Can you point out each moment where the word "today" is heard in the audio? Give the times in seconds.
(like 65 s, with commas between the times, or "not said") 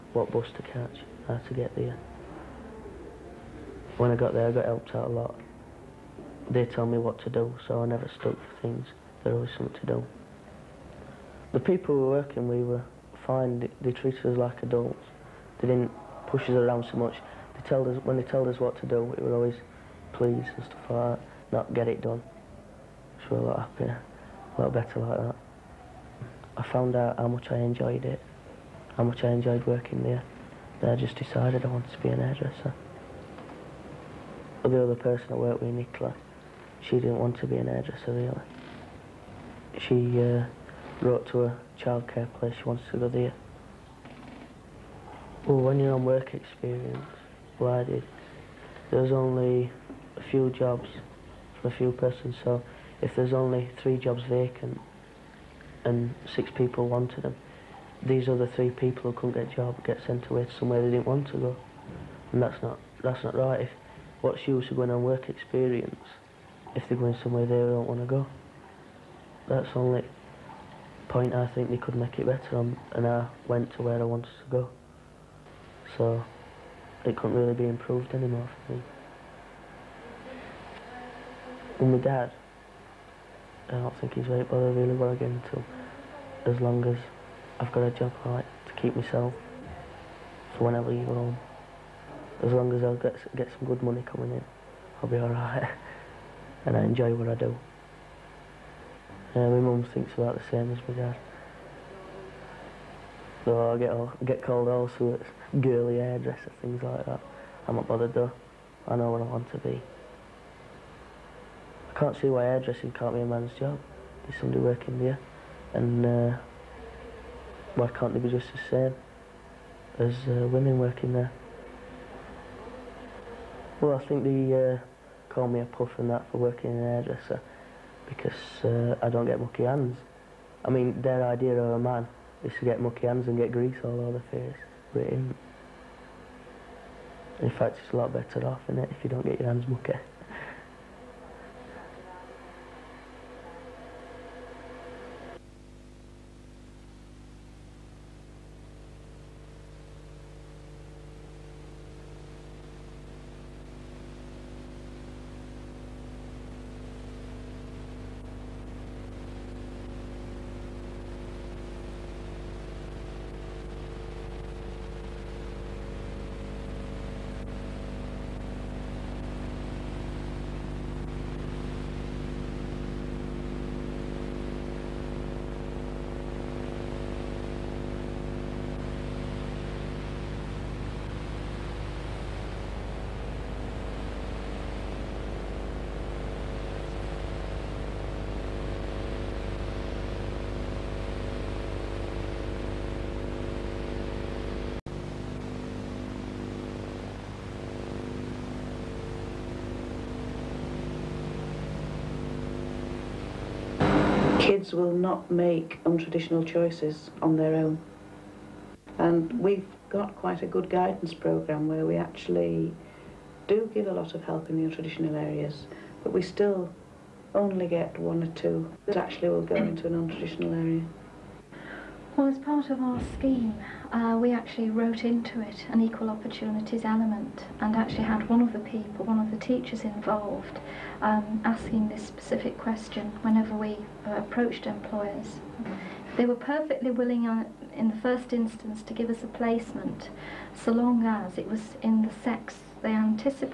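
not said.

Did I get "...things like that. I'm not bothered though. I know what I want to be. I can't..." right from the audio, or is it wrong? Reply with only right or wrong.
right.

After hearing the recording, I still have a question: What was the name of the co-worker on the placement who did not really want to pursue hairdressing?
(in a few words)
Nicola.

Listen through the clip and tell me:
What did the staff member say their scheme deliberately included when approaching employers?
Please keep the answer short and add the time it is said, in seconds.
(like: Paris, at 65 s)
equal opportunities, at 225 s.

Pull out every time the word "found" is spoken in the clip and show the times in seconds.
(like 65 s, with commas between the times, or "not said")
26 s.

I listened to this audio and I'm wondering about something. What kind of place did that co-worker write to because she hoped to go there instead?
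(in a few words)
childcare place.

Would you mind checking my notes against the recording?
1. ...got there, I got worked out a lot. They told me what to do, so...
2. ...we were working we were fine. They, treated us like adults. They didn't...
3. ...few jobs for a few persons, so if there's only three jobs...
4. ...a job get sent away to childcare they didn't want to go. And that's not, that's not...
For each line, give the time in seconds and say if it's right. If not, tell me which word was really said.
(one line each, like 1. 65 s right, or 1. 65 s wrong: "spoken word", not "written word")
1. 4 s wrong: "helped", not "worked"
2. 11 s right
3. 50 s right
4. 59 s wrong: "somewhere", not "childcare".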